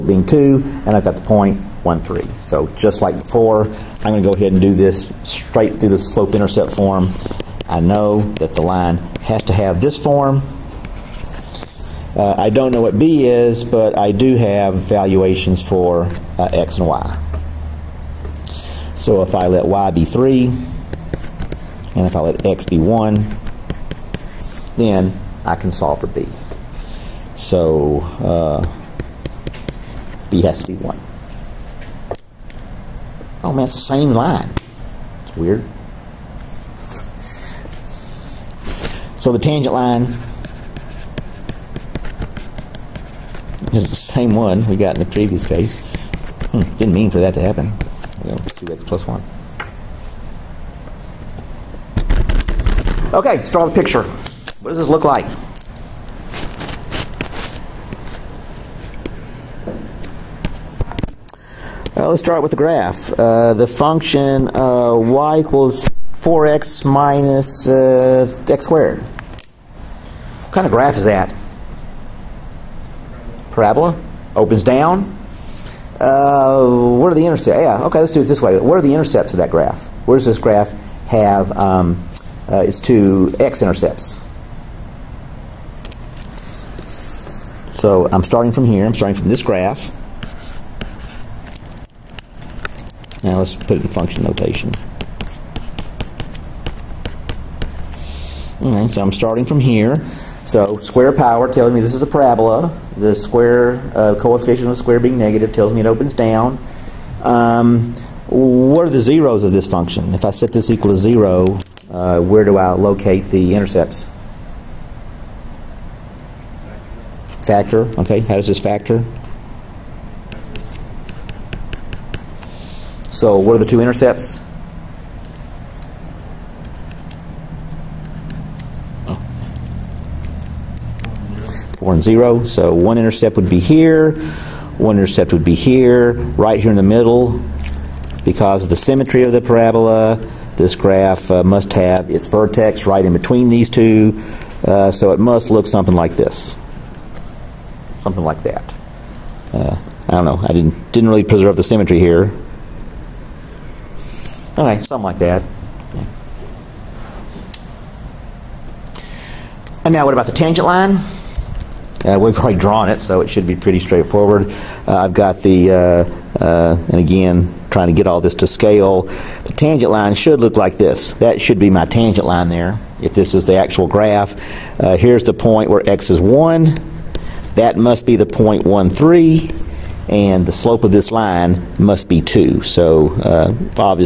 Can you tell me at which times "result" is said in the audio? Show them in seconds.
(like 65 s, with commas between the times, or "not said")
not said.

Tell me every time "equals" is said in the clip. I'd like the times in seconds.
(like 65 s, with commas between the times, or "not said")
65 s, 110 s.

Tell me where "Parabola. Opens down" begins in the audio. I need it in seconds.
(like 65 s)
73 s.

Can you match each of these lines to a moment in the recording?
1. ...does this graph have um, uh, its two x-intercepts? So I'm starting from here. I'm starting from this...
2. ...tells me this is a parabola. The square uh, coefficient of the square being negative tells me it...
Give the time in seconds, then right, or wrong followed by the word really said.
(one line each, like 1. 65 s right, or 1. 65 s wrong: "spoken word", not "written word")
1. 80 s right
2. 101 s right.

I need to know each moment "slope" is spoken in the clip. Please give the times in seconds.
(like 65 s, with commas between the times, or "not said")
5 s, 180 s.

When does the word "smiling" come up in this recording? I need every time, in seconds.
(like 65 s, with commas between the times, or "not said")
not said.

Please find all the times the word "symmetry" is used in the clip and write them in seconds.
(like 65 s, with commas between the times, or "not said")
138 s, 151 s.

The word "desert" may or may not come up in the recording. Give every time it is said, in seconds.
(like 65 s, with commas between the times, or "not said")
not said.